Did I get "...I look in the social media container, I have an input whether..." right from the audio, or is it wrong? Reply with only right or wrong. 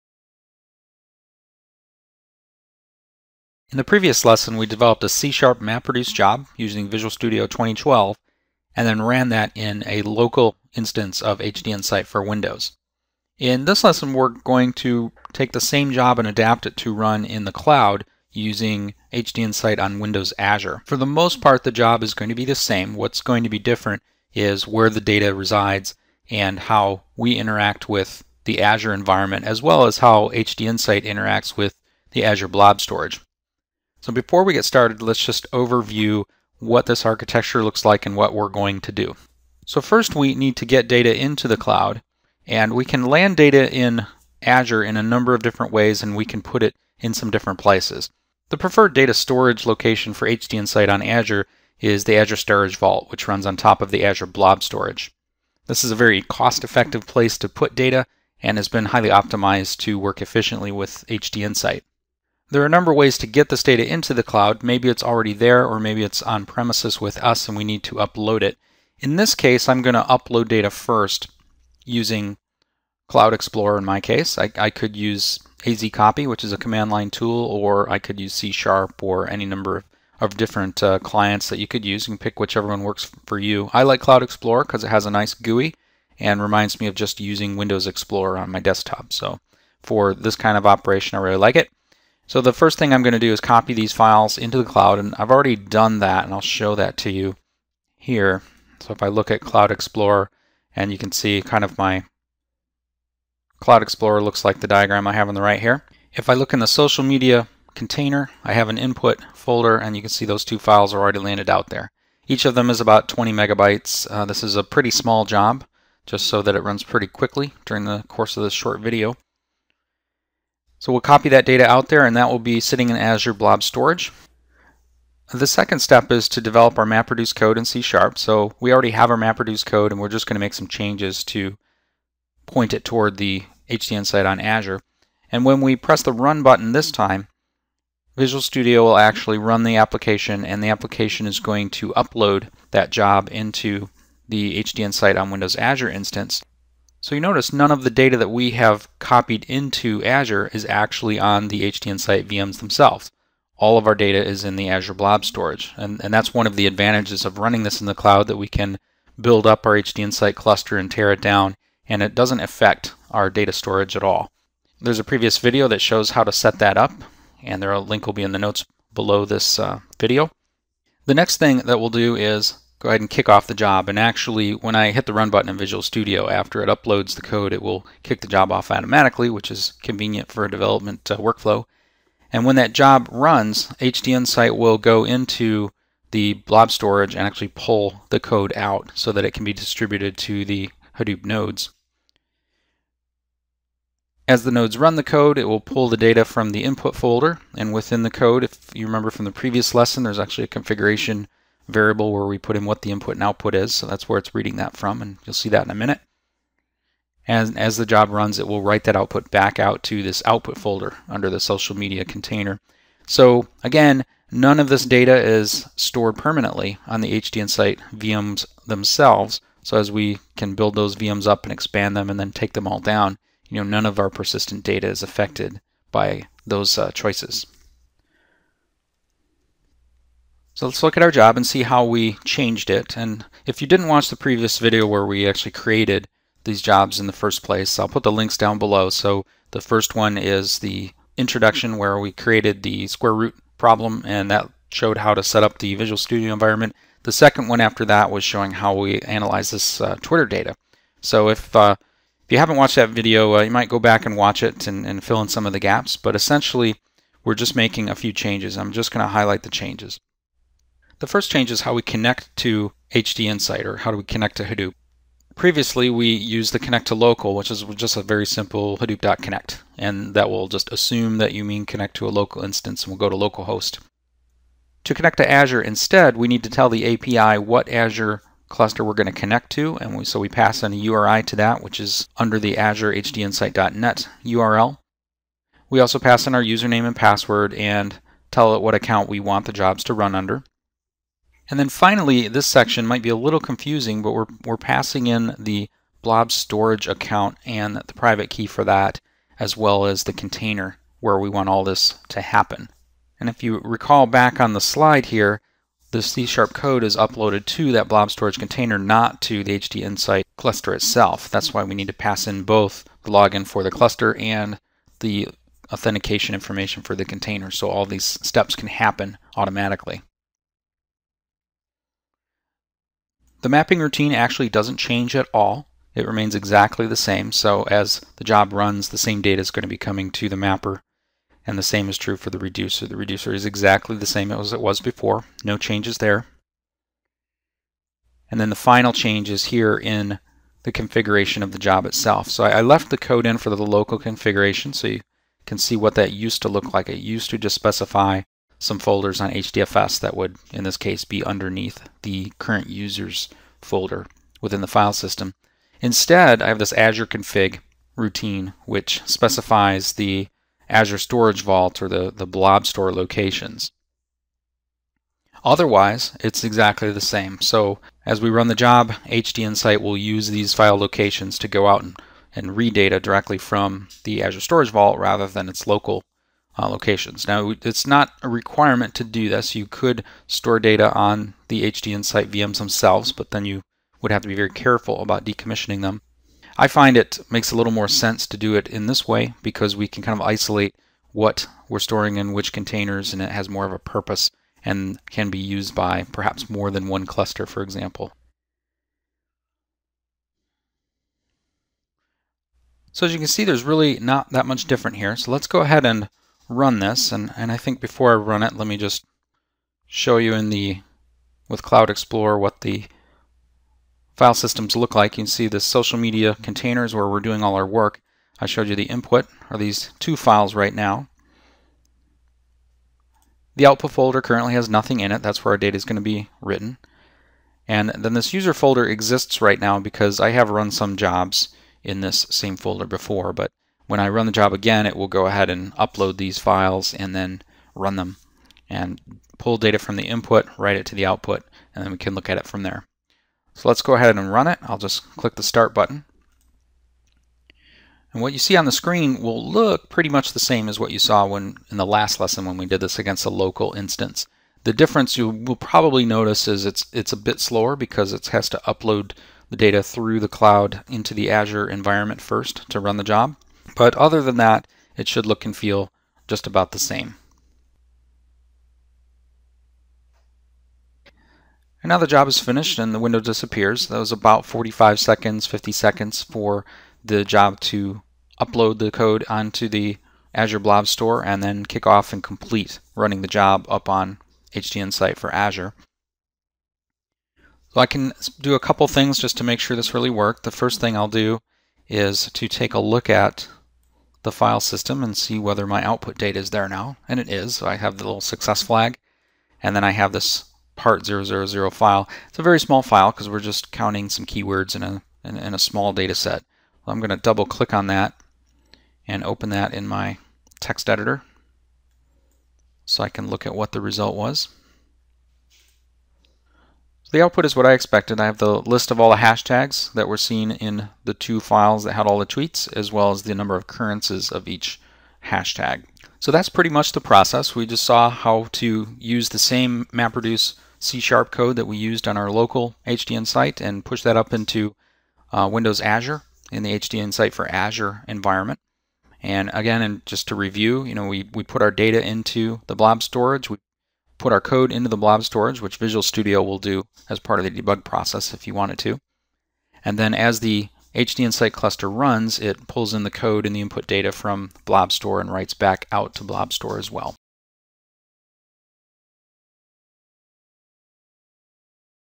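wrong.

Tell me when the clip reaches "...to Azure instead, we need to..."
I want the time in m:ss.
4:35.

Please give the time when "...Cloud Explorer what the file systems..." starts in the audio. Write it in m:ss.
6:51.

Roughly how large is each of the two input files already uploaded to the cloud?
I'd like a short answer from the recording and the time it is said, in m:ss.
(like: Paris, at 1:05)
20 megabytes, at 1:52.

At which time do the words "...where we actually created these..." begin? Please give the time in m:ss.
3:54.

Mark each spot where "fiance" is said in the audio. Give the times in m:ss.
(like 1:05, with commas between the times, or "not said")
not said.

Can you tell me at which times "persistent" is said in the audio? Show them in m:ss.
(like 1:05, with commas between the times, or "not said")
3:44.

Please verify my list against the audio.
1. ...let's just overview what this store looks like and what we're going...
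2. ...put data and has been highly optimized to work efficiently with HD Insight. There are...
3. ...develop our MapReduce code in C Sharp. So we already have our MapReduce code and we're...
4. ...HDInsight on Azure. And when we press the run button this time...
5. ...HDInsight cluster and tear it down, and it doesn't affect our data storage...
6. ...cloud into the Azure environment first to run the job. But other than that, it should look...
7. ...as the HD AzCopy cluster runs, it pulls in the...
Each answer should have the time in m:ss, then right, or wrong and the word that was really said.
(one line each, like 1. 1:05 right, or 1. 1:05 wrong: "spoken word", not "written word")
1. 0:35 wrong: "architecture", not "store"
2. 0:57 right
3. 2:06 right
4. 2:13 right
5. 2:39 right
6. 7:40 right
7. 9:10 wrong: "Insight", not "AzCopy".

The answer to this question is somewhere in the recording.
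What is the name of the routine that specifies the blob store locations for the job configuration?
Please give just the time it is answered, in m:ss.
5:56.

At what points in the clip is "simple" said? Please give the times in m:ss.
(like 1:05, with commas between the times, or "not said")
4:28.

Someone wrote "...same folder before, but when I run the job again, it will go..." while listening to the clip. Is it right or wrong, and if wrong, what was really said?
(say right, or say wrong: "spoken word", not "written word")
right.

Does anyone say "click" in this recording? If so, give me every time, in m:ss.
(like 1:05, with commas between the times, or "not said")
7:25, 8:27.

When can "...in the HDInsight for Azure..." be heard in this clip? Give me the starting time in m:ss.
8:56.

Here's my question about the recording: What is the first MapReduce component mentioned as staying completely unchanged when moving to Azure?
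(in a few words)
mapping routine.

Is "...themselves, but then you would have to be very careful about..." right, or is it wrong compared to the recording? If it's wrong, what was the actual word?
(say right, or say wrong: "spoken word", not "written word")
right.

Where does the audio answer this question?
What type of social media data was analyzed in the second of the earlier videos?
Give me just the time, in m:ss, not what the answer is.
4:10.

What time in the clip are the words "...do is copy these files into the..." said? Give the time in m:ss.
1:33.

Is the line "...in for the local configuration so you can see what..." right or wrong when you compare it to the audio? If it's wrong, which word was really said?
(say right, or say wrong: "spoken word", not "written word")
right.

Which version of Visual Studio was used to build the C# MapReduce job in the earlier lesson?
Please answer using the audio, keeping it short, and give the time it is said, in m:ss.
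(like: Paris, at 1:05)
2012, at 0:06.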